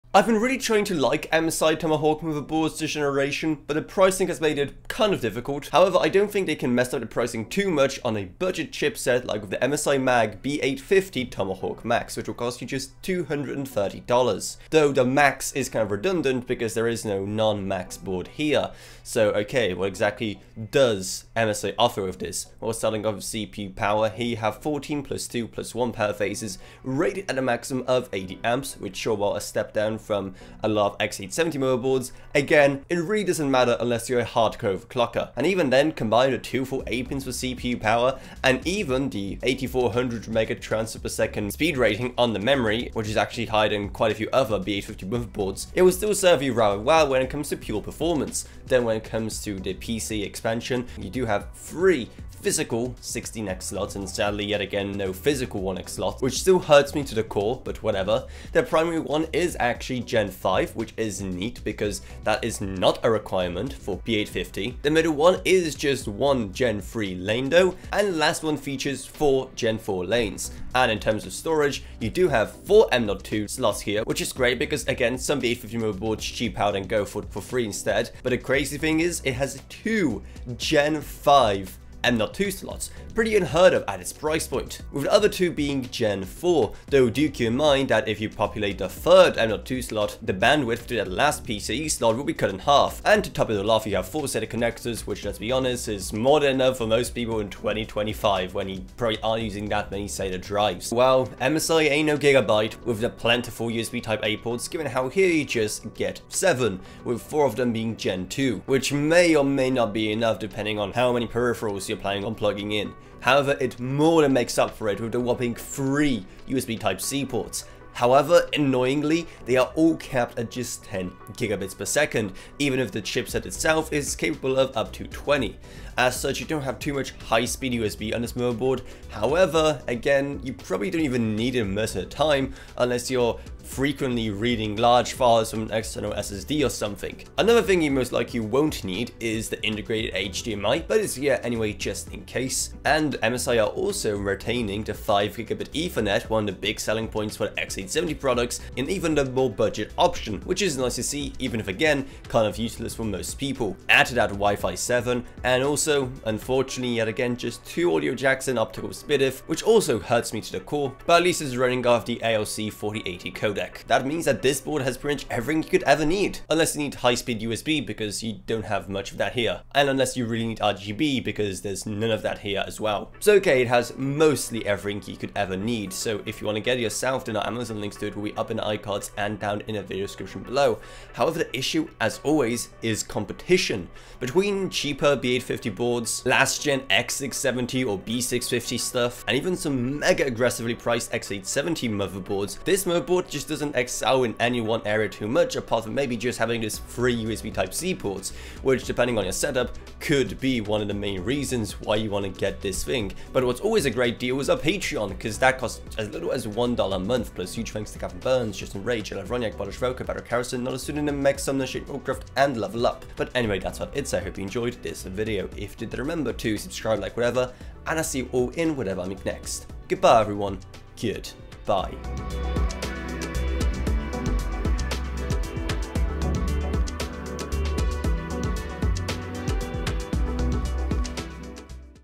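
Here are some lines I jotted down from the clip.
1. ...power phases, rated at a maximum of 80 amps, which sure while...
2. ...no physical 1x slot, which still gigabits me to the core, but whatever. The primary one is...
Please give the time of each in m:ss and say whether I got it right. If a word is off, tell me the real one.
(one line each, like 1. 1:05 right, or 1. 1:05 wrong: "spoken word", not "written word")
1. 0:25 right
2. 0:54 wrong: "hurts", not "gigabits".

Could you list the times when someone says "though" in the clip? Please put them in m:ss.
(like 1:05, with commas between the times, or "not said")
0:14, 1:07, 1:26.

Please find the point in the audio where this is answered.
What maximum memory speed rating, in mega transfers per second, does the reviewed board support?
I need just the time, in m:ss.
0:39.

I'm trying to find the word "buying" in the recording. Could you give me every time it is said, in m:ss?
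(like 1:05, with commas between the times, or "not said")
not said.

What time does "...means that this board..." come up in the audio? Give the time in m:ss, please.
2:44.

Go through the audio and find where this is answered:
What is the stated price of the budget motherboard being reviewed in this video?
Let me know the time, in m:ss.
0:13.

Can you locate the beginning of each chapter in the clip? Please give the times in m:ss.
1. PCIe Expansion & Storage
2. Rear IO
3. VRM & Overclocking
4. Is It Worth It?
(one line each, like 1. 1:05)
1. 0:48
2. 1:41
3. 0:22
4. 2:44.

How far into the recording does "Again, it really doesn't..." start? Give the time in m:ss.
0:32.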